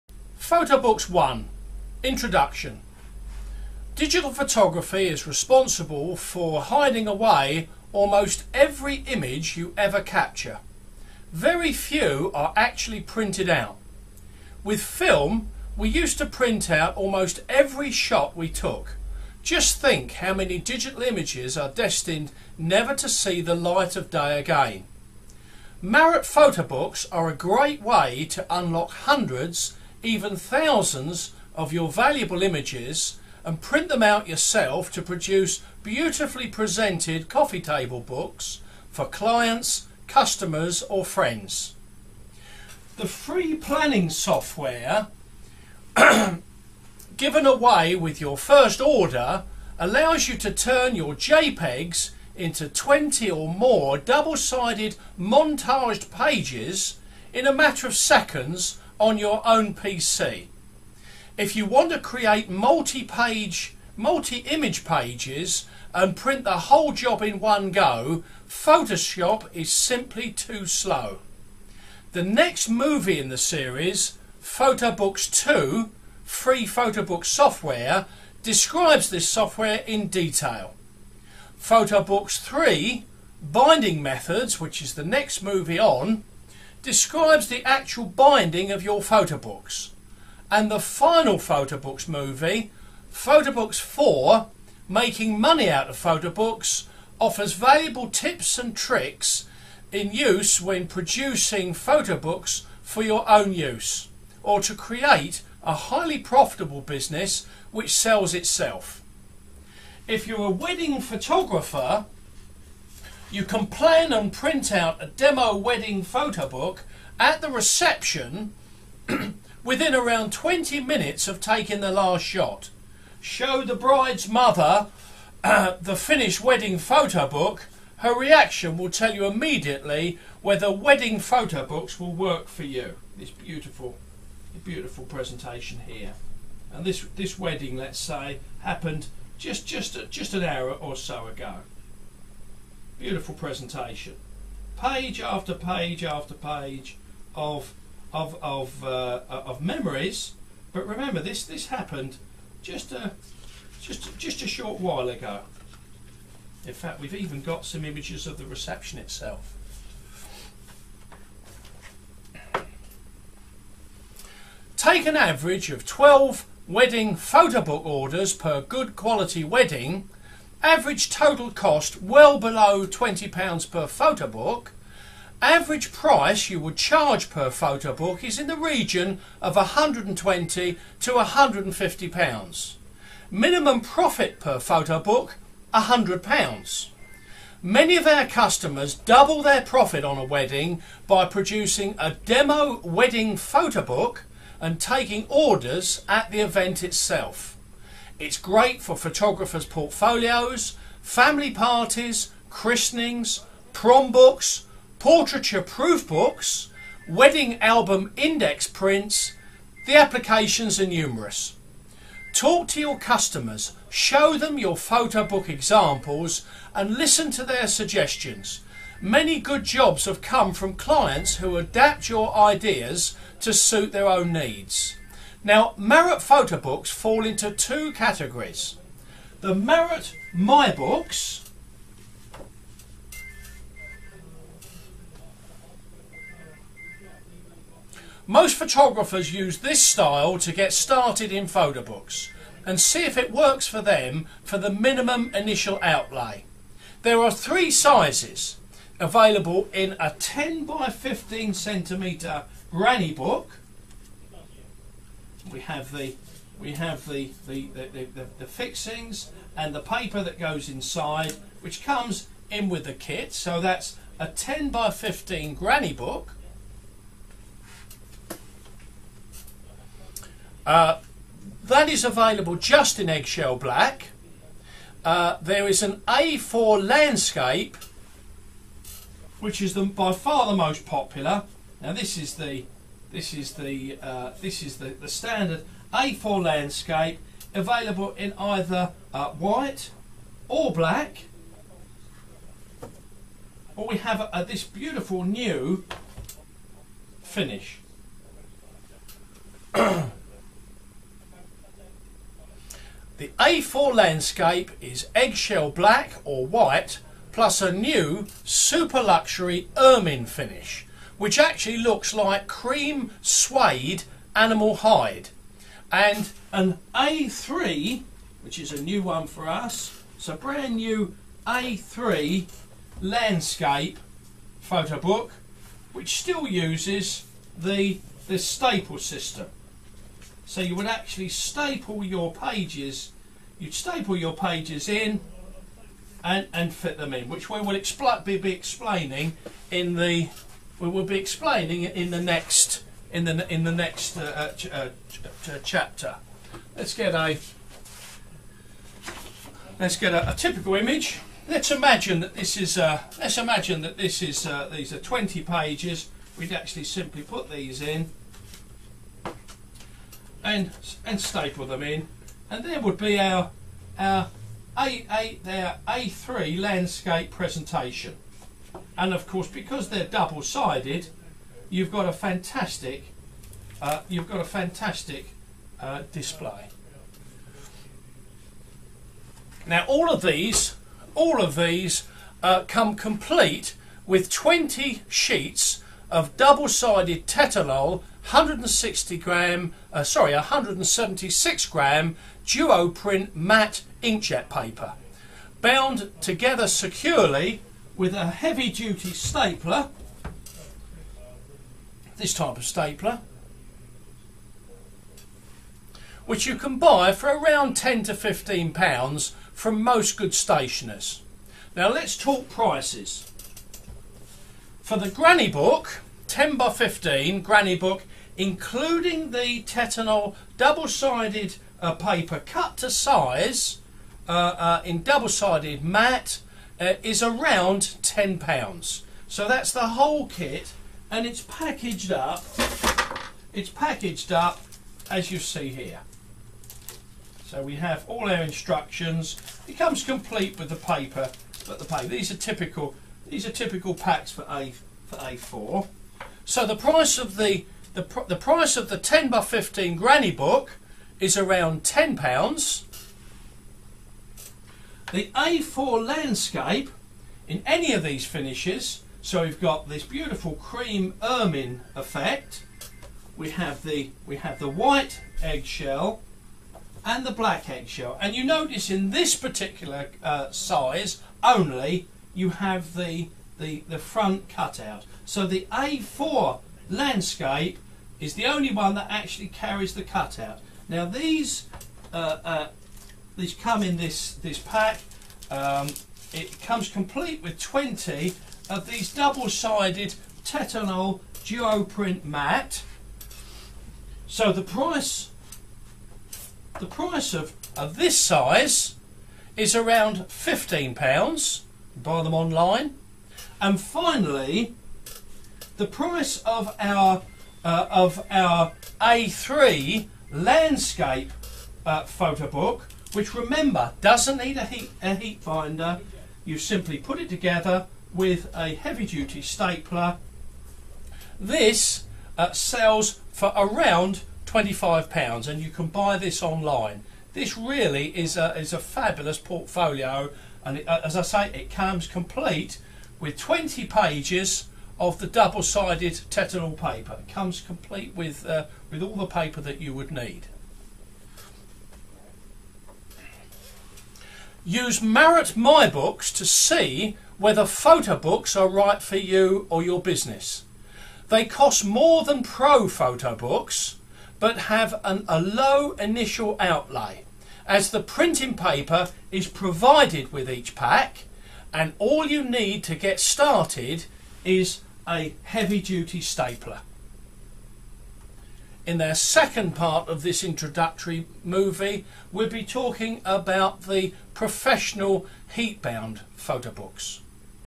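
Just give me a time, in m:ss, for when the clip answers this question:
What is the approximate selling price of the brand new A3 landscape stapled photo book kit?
8:44.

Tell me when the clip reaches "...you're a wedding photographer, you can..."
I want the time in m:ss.
1:50.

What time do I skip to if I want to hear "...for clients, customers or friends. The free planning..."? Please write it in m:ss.
0:38.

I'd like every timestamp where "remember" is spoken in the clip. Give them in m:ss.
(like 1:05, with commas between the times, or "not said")
2:30, 8:33.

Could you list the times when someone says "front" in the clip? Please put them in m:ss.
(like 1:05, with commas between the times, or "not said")
7:53.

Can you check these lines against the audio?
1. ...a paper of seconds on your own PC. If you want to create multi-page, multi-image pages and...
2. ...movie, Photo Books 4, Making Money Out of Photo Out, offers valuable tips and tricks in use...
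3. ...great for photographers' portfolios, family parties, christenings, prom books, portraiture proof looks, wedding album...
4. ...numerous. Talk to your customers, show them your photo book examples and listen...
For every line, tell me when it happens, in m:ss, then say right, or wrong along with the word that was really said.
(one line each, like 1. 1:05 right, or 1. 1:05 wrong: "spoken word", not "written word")
1. 0:57 wrong: "matter", not "paper"
2. 1:32 wrong: "Books", not "Out"
3. 3:18 wrong: "books", not "looks"
4. 3:30 right.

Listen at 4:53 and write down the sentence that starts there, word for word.
Or we have uh, this beautiful new finish.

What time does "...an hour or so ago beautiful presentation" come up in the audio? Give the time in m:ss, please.
2:20.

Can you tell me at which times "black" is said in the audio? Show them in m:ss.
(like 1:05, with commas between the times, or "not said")
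4:33, 4:50, 5:05, 7:47.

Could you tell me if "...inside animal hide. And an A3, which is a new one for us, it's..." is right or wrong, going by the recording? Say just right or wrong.
wrong.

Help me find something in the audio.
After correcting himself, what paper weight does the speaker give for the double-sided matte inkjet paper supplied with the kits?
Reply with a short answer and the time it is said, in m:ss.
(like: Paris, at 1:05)
176 gram, at 6:30.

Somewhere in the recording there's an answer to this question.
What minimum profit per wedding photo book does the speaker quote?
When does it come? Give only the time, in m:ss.
3:05.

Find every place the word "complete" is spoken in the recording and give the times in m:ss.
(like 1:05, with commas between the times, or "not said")
6:22, 7:20, 8:06, 8:52, 8:57.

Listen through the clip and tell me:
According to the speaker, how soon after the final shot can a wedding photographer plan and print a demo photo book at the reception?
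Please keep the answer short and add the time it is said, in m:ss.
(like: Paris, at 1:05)
around 20 minutes, at 1:59.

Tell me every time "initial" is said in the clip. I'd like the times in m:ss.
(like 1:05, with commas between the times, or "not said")
4:05, 9:15.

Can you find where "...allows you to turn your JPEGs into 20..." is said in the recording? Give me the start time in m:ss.
0:49.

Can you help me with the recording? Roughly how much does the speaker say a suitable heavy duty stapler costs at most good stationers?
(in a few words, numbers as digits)
£10 to £15.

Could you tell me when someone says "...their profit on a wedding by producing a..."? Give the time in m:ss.
3:09.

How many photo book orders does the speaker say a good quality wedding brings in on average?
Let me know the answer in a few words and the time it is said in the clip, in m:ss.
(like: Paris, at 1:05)
12, at 2:45.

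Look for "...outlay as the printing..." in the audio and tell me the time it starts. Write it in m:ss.
9:16.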